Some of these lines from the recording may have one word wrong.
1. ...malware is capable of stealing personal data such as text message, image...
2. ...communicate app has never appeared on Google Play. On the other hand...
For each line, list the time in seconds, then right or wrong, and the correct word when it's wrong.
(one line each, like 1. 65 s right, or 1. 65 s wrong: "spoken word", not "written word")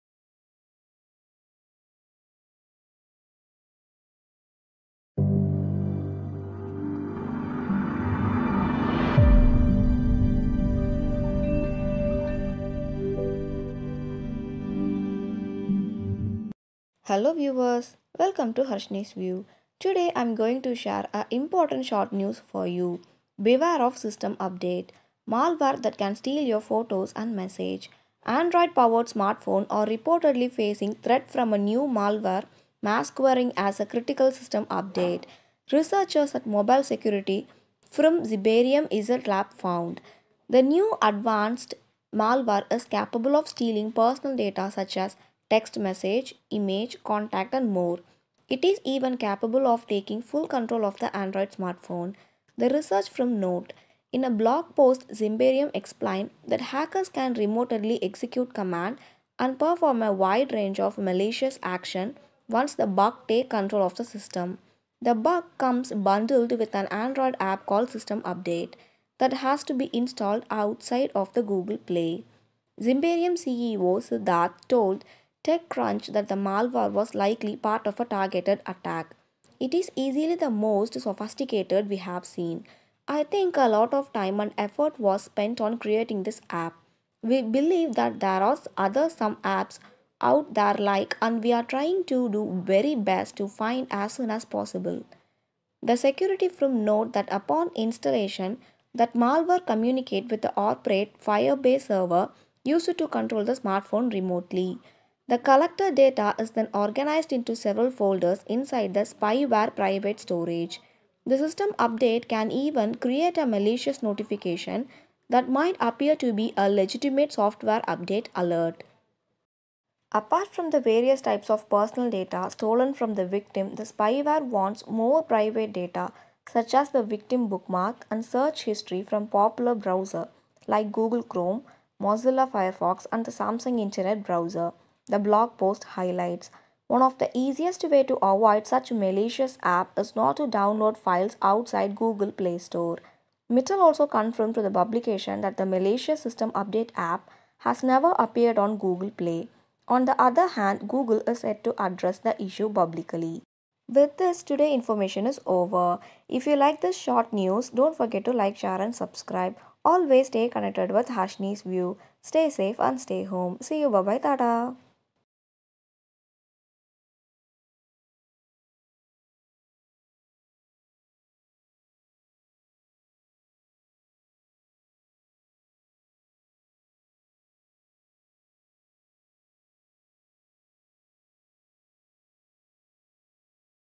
1. 42 s right
2. 146 s wrong: "update", not "communicate".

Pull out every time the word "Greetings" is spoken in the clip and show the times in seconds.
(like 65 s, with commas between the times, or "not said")
not said.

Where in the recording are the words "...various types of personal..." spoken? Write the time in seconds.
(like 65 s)
120 s.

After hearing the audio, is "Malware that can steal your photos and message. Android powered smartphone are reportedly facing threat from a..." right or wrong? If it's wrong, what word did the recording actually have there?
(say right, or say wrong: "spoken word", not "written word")
right.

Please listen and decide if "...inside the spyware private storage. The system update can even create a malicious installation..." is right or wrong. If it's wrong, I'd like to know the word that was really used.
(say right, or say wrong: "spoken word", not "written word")
wrong: "notification", not "installation".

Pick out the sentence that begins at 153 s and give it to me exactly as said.
With this, today information is over.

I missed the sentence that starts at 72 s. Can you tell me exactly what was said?
Zimperium CEO Siddharth told TechCrunch that the malware was likely part of a targeted attack.